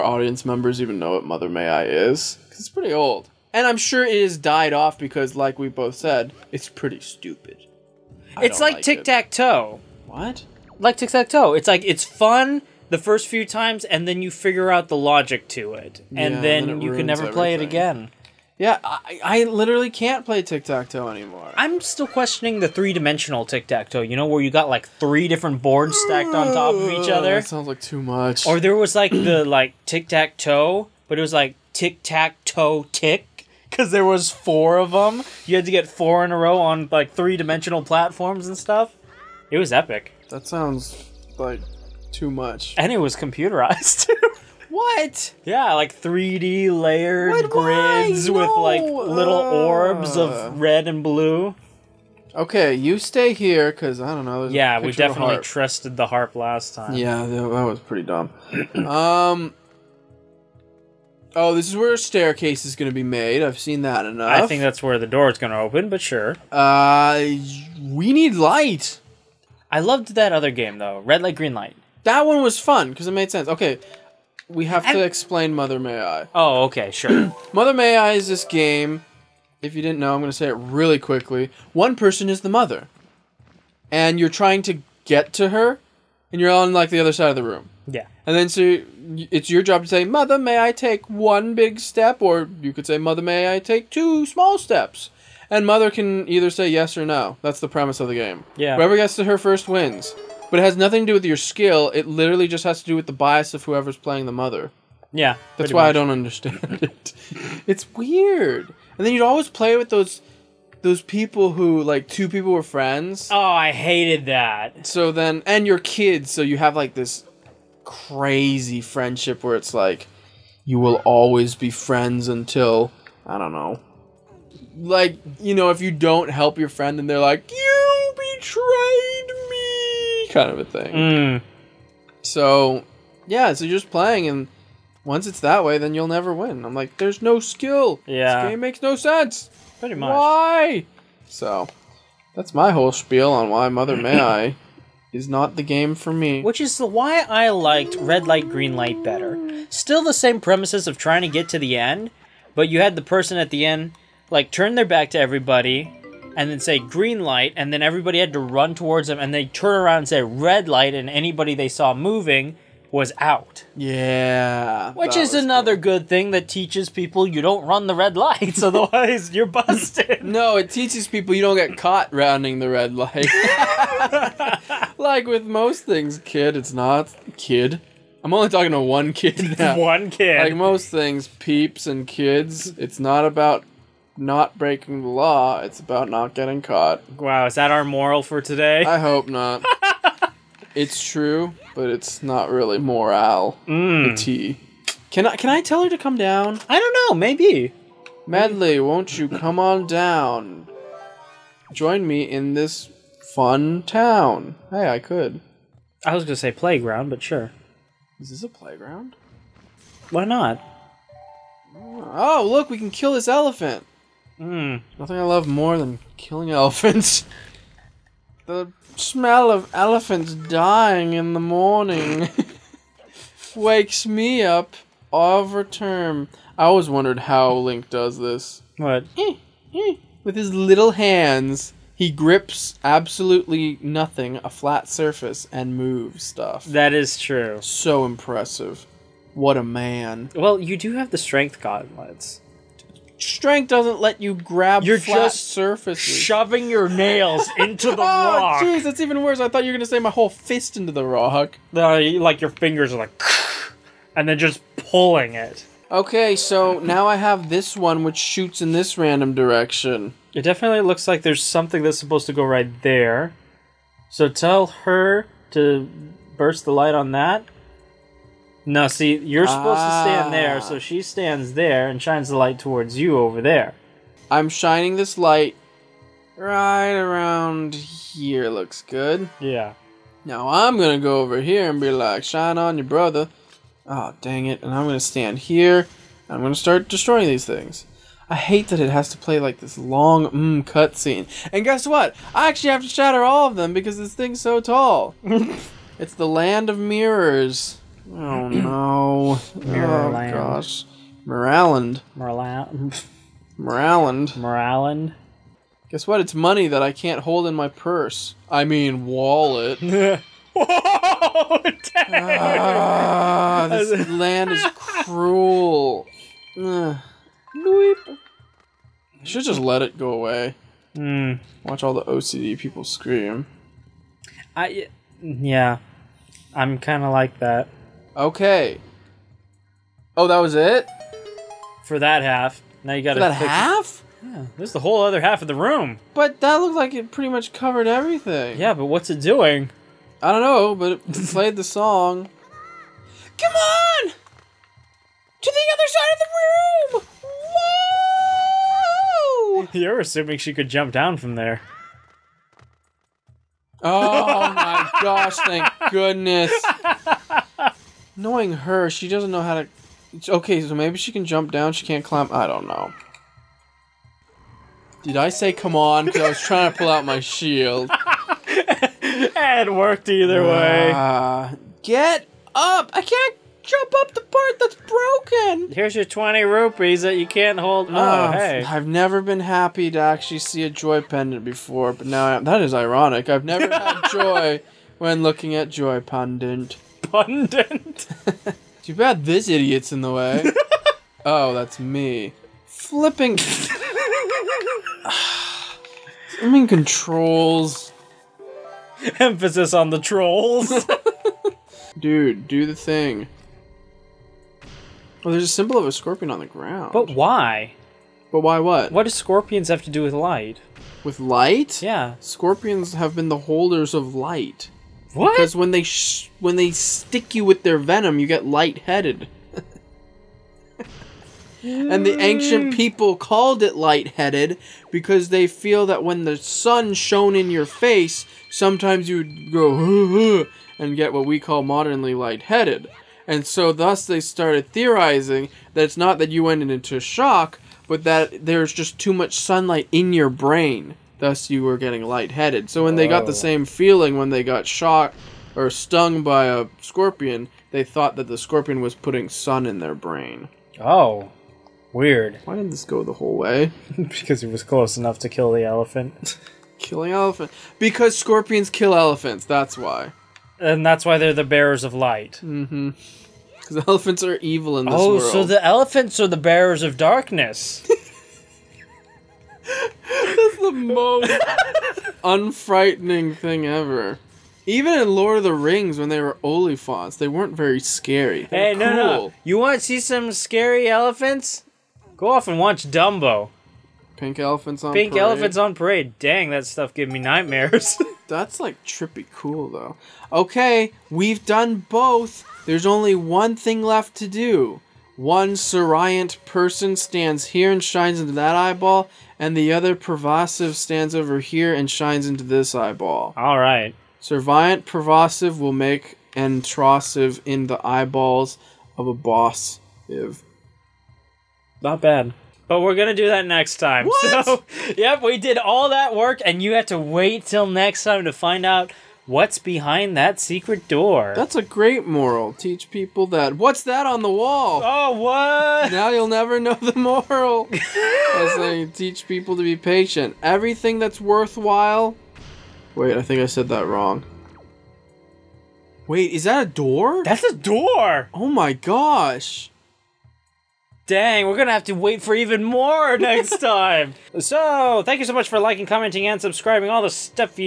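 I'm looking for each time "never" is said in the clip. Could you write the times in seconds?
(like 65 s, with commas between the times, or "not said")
17 s, 136 s, 378 s, 383 s, 526 s.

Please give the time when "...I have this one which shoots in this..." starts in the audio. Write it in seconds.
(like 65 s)
257 s.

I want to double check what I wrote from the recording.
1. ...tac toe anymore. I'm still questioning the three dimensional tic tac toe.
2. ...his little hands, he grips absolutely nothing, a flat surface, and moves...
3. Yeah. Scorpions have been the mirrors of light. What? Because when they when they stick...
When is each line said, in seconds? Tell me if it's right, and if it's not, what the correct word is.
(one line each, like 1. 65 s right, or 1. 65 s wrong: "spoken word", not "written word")
1. 20 s right
2. 230 s right
3. 411 s wrong: "holders", not "mirrors".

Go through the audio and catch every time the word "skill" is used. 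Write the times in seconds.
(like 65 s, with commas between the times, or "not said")
101 s, 137 s.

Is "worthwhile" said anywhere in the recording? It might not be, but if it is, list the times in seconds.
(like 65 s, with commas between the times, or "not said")
531 s.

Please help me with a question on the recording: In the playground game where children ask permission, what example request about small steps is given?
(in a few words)
Two small steps.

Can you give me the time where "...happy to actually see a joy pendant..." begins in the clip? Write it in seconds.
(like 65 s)
379 s.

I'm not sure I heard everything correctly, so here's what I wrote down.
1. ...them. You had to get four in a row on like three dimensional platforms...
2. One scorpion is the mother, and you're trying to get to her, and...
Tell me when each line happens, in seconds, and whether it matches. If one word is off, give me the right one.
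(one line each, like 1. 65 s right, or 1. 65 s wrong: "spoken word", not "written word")
1. 34 s right
2. 81 s wrong: "person", not "scorpion".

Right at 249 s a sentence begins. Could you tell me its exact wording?
I thought you were gonna say my whole fist into the rock.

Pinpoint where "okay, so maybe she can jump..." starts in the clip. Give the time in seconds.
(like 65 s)
360 s.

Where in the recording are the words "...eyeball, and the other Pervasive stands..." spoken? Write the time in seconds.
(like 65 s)
498 s.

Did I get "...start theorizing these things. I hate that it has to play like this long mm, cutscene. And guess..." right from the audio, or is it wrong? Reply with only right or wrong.
wrong.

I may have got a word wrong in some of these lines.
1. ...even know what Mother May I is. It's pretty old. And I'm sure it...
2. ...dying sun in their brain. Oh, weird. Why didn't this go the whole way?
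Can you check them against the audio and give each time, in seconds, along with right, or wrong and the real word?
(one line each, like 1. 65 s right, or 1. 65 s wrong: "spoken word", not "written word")
1. 0 s right
2. 448 s wrong: "putting", not "dying".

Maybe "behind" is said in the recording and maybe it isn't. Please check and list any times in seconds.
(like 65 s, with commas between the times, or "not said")
519 s.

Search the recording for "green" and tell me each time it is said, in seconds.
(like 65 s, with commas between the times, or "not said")
71 s, 148 s, 156 s.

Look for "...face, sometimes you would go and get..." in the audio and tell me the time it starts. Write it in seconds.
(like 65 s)
427 s.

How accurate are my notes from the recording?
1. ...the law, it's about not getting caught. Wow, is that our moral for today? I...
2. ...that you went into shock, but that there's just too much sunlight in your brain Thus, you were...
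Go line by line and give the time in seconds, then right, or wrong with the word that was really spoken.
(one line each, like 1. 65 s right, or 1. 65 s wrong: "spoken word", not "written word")
1. 185 s right
2. 436 s right.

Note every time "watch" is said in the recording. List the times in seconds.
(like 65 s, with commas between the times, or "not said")
321 s, 482 s.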